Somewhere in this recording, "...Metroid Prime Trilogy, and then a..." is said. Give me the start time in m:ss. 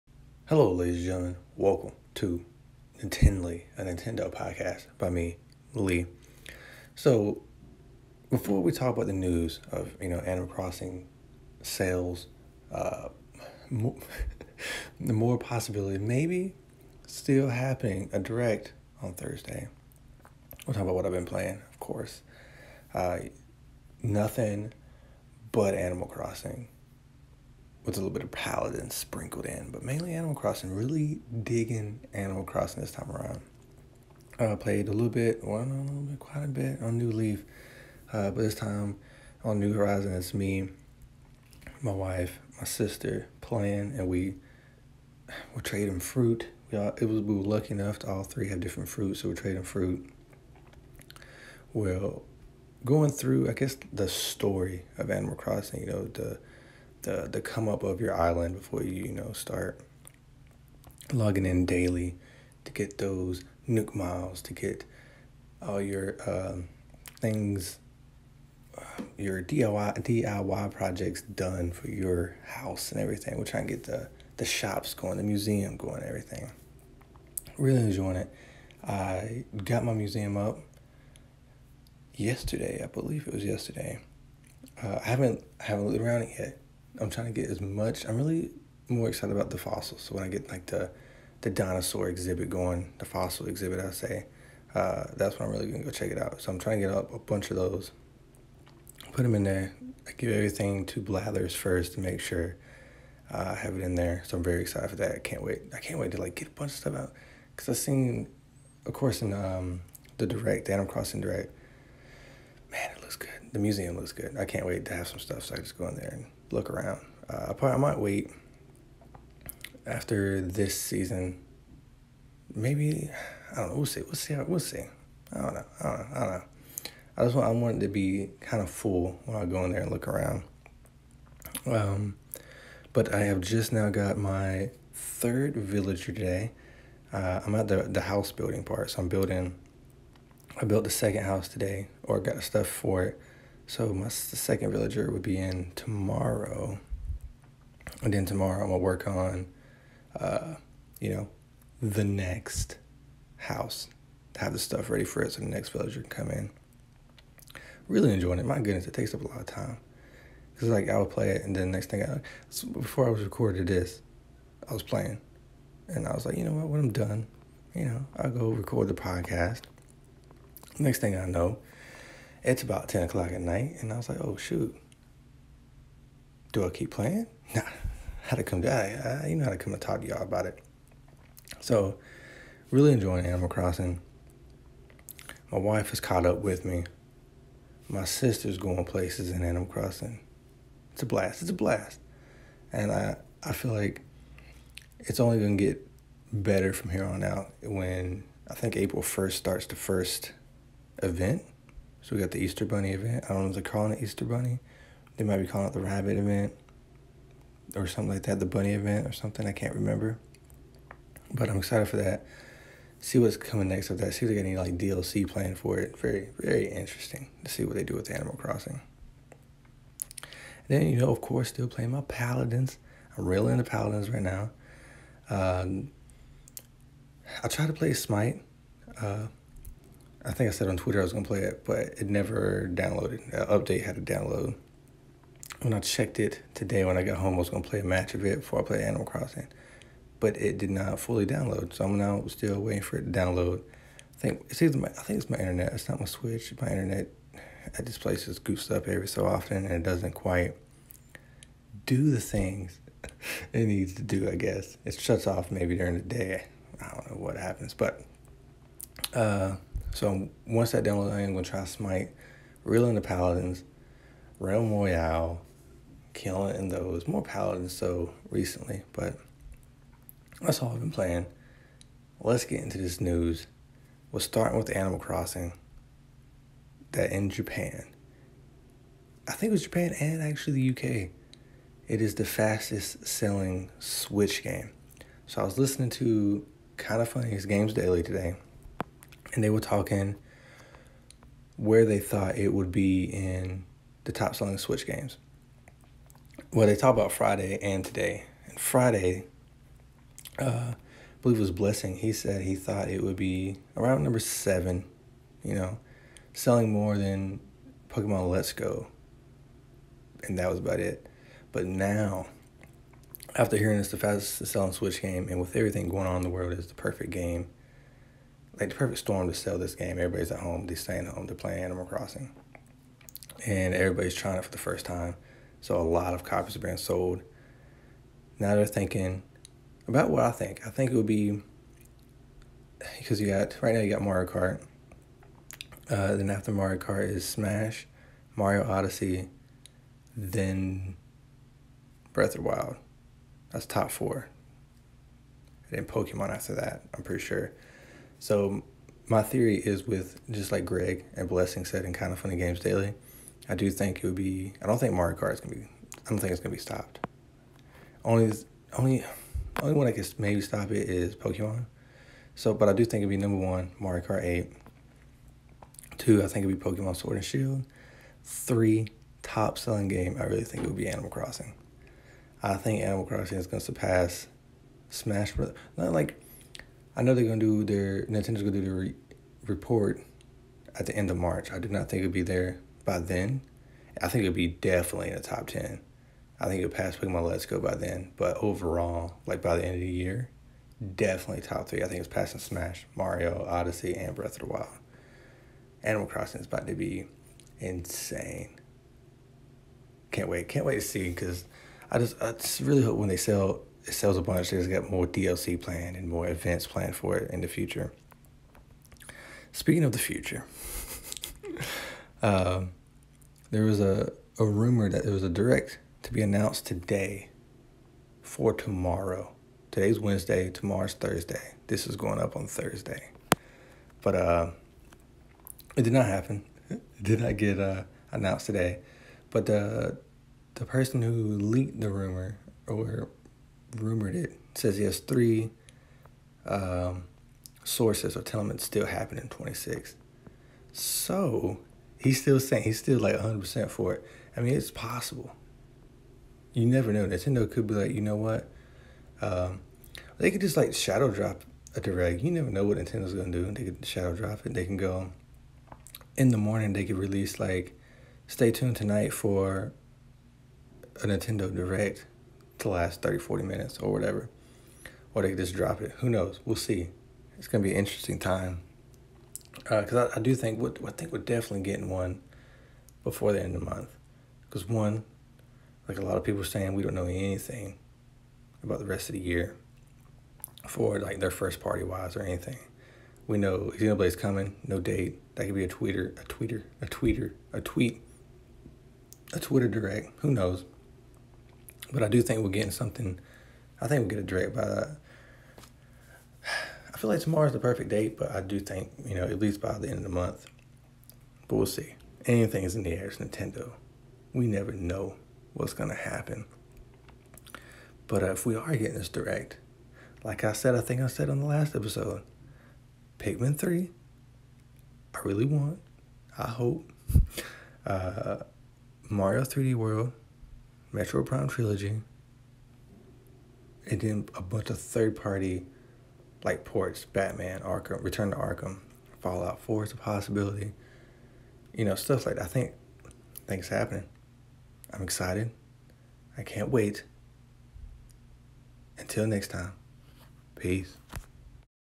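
8:40.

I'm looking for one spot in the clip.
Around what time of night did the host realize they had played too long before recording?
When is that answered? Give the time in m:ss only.
2:52.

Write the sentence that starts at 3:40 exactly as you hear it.
And then, you know, of course, still playing my Paladins.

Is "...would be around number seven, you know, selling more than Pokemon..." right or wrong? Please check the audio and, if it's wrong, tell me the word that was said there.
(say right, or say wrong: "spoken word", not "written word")
right.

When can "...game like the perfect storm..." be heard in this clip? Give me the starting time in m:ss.
5:17.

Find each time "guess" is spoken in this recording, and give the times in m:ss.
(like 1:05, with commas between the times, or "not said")
0:53, 4:14.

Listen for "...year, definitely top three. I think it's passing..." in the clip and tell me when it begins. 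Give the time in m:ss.
6:29.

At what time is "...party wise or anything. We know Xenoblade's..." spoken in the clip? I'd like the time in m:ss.
8:01.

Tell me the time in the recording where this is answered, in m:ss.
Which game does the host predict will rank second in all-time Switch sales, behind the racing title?
6:06.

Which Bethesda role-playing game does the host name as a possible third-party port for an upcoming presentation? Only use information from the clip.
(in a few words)
Fallout 4.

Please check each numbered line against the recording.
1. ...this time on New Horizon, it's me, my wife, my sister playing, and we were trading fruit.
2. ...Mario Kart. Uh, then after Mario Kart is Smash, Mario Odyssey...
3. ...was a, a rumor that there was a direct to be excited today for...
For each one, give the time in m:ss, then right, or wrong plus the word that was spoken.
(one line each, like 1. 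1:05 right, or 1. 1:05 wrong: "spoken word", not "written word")
1. 0:38 right
2. 5:34 right
3. 6:53 wrong: "announced", not "excited".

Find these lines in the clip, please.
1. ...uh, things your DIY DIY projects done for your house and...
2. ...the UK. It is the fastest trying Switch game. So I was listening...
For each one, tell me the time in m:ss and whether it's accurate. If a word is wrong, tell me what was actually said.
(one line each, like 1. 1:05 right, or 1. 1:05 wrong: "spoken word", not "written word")
1. 1:07 right
2. 4:40 wrong: "selling", not "trying".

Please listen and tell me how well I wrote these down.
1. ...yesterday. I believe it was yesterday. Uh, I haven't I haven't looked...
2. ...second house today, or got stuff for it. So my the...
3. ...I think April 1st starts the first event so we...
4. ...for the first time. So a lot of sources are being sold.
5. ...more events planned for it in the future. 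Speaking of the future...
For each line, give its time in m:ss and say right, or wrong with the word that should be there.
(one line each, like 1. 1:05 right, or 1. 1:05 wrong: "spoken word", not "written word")
1. 1:22 right
2. 2:20 right
3. 3:18 right
4. 5:24 wrong: "copies", not "sources"
5. 6:46 right.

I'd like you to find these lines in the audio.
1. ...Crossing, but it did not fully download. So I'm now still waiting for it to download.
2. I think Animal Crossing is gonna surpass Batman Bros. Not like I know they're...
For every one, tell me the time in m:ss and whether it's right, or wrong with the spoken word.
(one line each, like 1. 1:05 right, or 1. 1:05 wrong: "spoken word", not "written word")
1. 3:59 right
2. 6:12 wrong: "Smash", not "Batman".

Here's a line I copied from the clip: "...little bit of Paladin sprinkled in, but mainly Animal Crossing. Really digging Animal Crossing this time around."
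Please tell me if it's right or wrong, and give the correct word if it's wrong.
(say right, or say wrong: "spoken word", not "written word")
right.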